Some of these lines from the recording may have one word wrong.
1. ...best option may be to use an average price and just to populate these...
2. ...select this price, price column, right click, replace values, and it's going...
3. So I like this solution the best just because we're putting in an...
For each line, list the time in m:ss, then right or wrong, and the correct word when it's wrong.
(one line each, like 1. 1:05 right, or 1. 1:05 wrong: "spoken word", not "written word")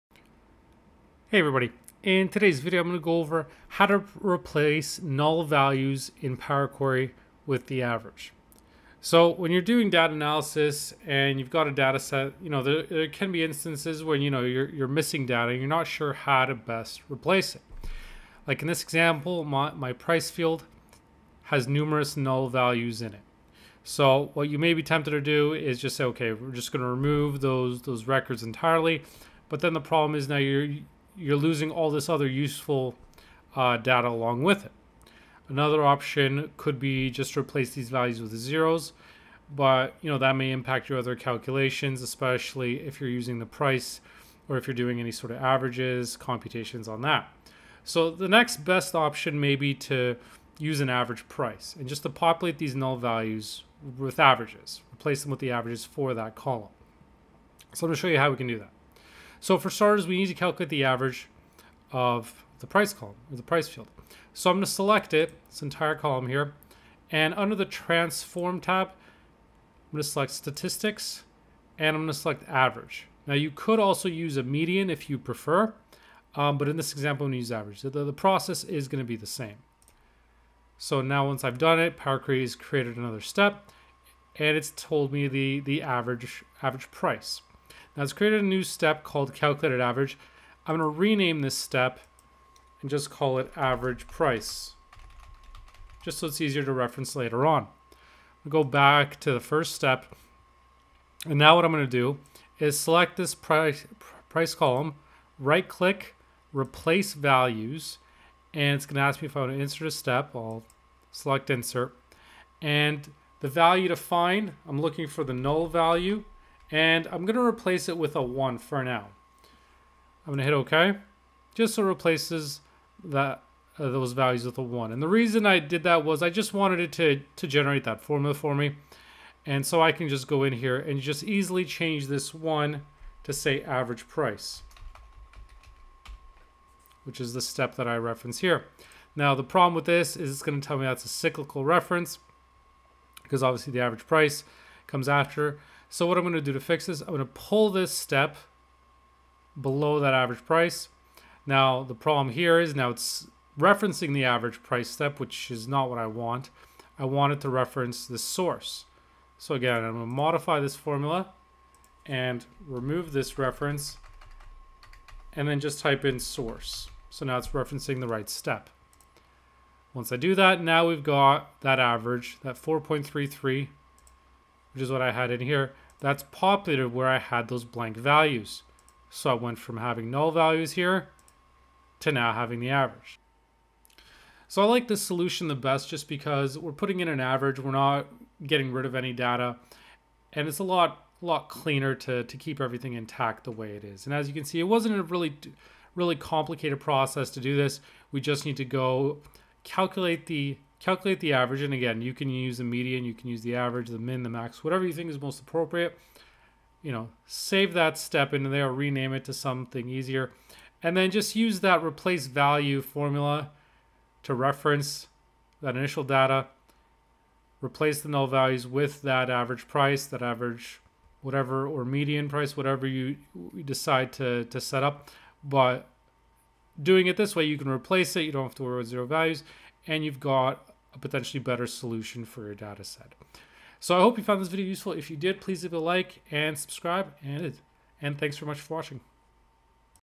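1. 0:48 right
2. 1:42 right
3. 3:04 right.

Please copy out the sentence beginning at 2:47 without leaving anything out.
So now it's referencing the right step.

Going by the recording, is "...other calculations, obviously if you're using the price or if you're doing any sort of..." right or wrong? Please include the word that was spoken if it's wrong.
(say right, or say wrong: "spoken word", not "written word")
wrong: "especially", not "obviously".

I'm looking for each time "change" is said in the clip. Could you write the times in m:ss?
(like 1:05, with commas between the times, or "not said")
2:11.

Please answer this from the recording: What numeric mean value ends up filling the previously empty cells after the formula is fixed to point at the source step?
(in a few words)
4.33.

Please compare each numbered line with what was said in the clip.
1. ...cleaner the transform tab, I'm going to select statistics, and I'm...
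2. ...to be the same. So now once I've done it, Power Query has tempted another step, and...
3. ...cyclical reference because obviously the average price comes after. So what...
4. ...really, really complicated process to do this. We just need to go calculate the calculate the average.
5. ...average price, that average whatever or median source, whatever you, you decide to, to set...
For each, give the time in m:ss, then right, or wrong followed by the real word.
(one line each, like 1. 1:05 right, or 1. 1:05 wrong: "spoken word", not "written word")
1. 1:07 wrong: "under", not "cleaner"
2. 1:19 wrong: "created", not "tempted"
3. 2:21 right
4. 3:15 right
5. 3:39 wrong: "price", not "source".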